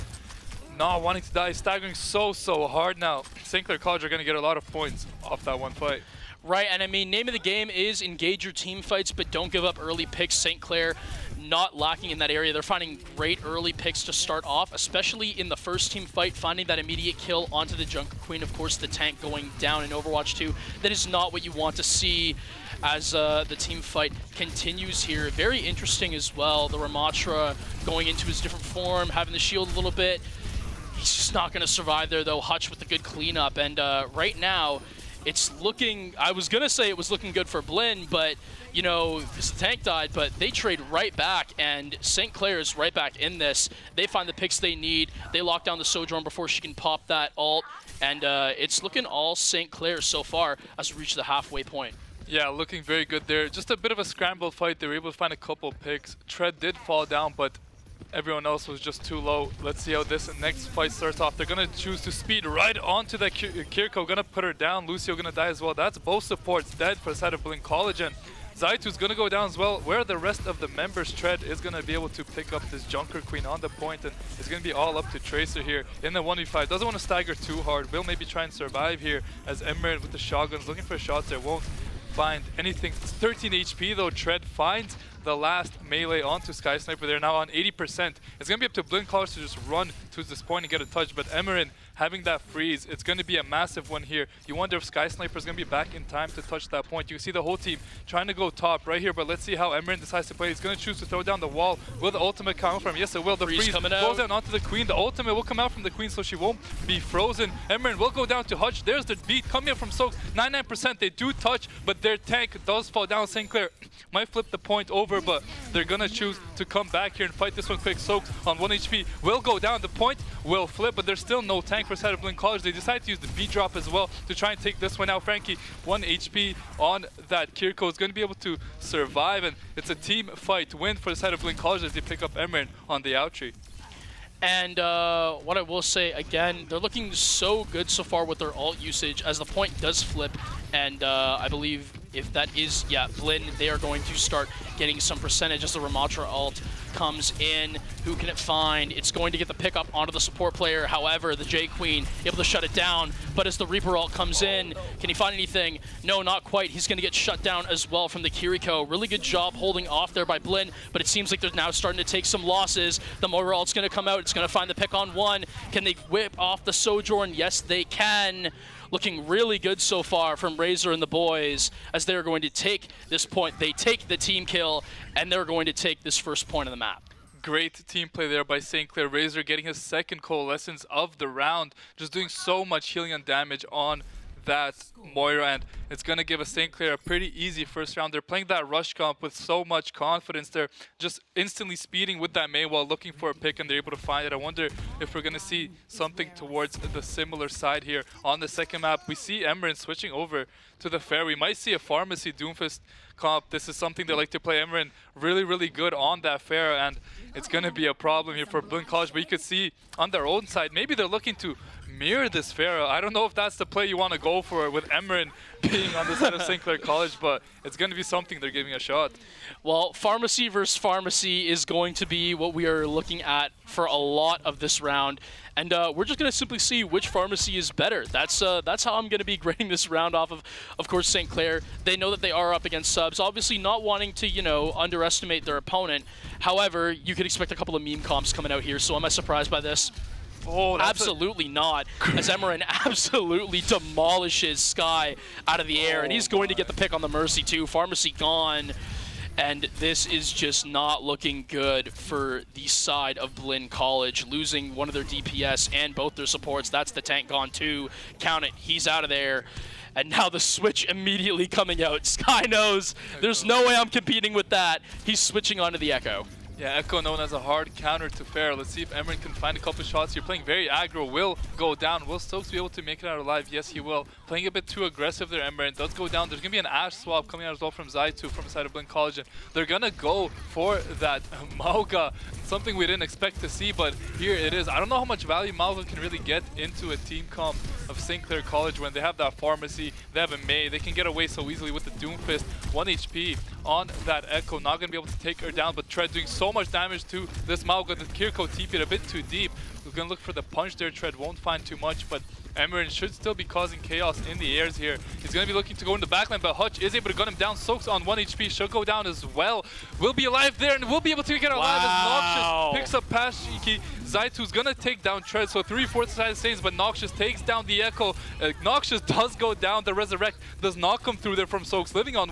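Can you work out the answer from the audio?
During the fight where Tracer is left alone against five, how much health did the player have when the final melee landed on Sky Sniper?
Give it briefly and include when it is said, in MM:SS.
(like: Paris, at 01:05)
13 HP, at 01:22.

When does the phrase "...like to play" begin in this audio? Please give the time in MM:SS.
03:24.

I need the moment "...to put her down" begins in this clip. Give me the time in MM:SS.
01:04.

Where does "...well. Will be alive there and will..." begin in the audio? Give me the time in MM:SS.
05:09.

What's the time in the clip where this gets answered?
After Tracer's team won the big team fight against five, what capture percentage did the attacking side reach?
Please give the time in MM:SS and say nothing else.
01:27.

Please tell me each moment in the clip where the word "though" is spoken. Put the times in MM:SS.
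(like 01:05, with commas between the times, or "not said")
00:32, 01:23.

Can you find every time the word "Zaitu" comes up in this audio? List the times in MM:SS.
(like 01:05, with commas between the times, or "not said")
01:08, 04:37, 05:14.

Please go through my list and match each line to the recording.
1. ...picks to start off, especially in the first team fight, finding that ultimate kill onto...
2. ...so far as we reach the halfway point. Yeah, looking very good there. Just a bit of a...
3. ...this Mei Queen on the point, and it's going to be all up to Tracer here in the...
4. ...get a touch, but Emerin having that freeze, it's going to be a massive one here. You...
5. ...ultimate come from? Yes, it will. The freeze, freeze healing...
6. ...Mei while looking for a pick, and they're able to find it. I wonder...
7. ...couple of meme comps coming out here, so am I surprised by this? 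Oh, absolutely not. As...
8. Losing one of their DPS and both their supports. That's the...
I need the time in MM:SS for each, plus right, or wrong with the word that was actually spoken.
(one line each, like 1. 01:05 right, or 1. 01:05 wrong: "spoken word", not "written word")
1. 00:13 wrong: "immediate", not "ultimate"
2. 00:50 right
3. 01:12 wrong: "Junker", not "Mei"
4. 01:30 right
5. 01:42 wrong: "coming", not "healing"
6. 03:12 right
7. 03:57 right
8. 04:14 right.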